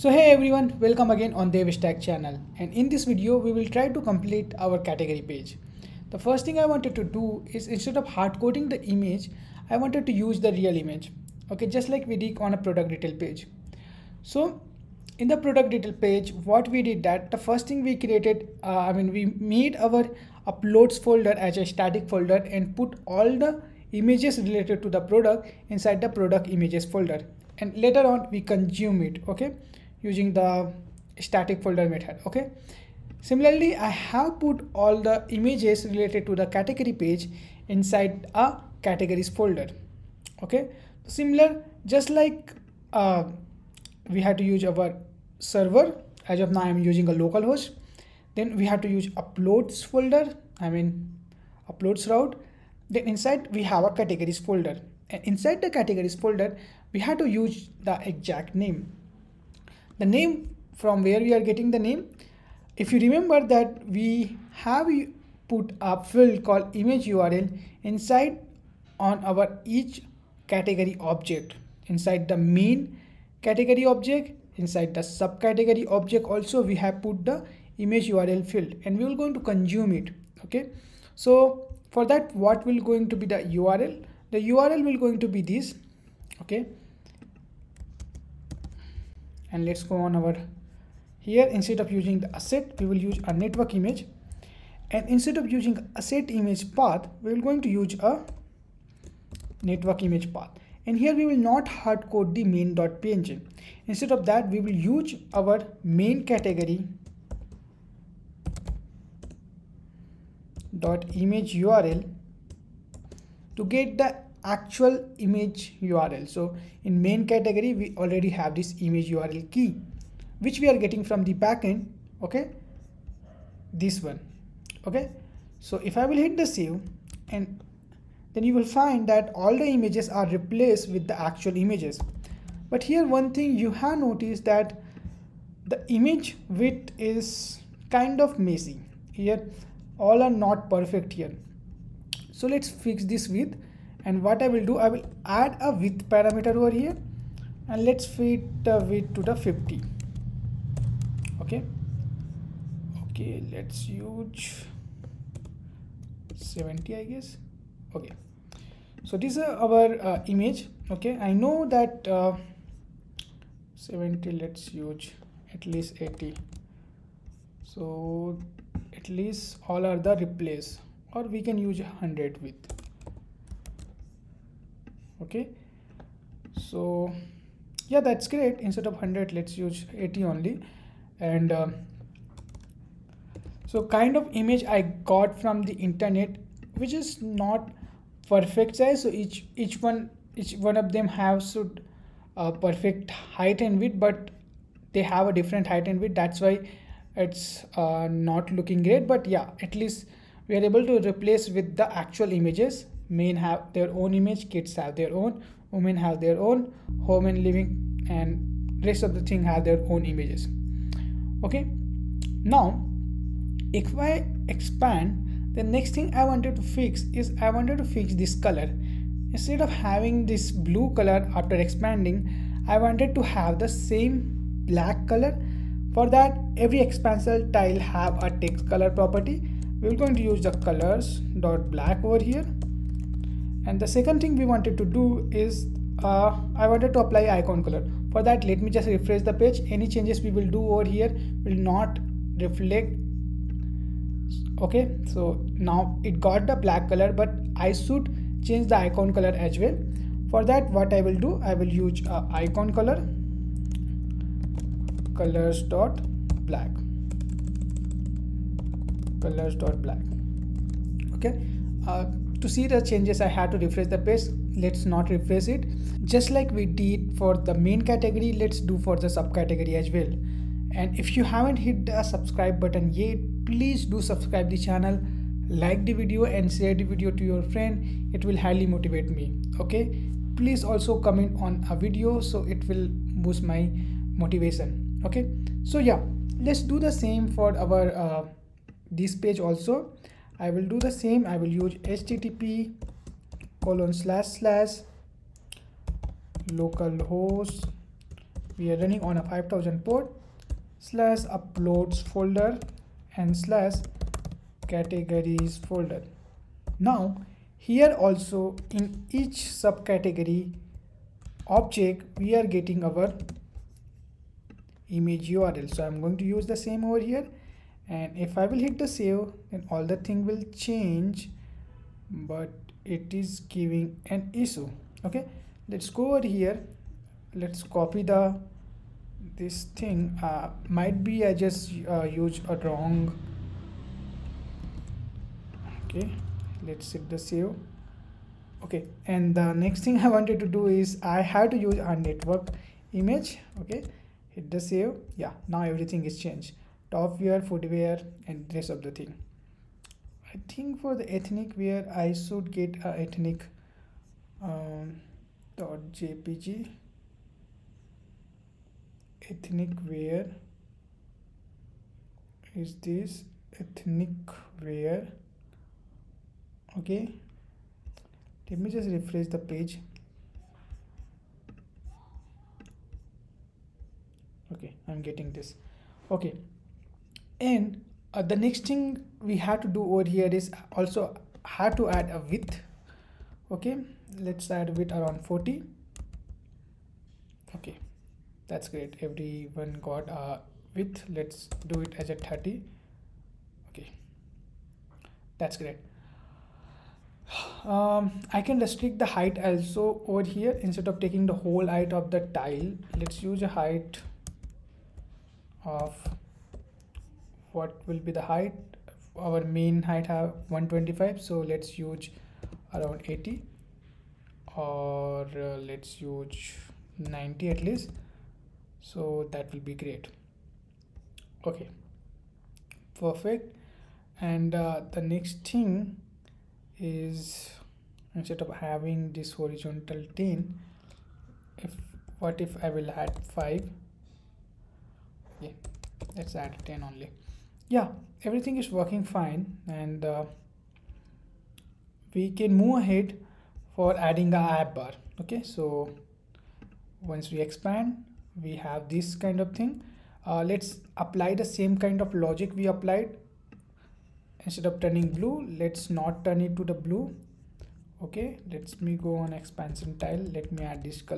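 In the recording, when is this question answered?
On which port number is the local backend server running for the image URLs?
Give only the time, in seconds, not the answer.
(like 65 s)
299 s.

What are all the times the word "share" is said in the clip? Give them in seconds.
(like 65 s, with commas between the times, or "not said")
276 s.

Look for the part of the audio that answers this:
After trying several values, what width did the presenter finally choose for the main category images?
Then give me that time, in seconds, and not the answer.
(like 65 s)
179 s.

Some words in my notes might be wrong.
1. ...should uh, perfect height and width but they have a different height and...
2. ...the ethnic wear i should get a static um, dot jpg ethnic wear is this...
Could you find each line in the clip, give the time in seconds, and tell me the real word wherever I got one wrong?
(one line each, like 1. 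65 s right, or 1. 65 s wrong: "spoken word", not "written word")
1. 191 s right
2. 350 s wrong: "ethnic", not "static".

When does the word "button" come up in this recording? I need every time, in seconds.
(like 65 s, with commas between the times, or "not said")
272 s.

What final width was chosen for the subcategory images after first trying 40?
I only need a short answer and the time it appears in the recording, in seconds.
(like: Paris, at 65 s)
30, at 391 s.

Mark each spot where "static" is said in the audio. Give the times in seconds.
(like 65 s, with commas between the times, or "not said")
21 s, 31 s.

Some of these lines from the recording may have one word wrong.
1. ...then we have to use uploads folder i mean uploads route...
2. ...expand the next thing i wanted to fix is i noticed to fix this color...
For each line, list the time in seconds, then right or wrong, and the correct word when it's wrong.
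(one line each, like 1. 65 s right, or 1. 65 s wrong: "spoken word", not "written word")
1. 48 s right
2. 214 s wrong: "wanted", not "noticed".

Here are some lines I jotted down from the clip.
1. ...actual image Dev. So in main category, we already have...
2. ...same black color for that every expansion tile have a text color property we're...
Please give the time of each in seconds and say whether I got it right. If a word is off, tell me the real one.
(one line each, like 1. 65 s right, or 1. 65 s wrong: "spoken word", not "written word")
1. 114 s wrong: "URL", not "Dev"
2. 223 s right.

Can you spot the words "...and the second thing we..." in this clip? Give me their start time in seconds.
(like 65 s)
233 s.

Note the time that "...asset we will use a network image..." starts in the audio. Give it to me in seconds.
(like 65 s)
92 s.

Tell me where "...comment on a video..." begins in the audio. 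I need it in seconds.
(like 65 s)
281 s.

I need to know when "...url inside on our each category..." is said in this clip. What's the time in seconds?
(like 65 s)
67 s.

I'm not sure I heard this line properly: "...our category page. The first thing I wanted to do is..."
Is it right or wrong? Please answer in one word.
right.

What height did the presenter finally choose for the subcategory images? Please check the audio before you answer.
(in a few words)
90.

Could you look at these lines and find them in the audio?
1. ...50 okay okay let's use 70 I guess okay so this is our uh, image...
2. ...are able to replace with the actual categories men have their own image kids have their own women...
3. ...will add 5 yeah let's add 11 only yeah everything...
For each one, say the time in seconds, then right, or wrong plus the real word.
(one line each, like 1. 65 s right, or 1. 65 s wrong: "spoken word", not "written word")
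1. 149 s right
2. 200 s wrong: "images", not "categories"
3. 432 s wrong: "10", not "11".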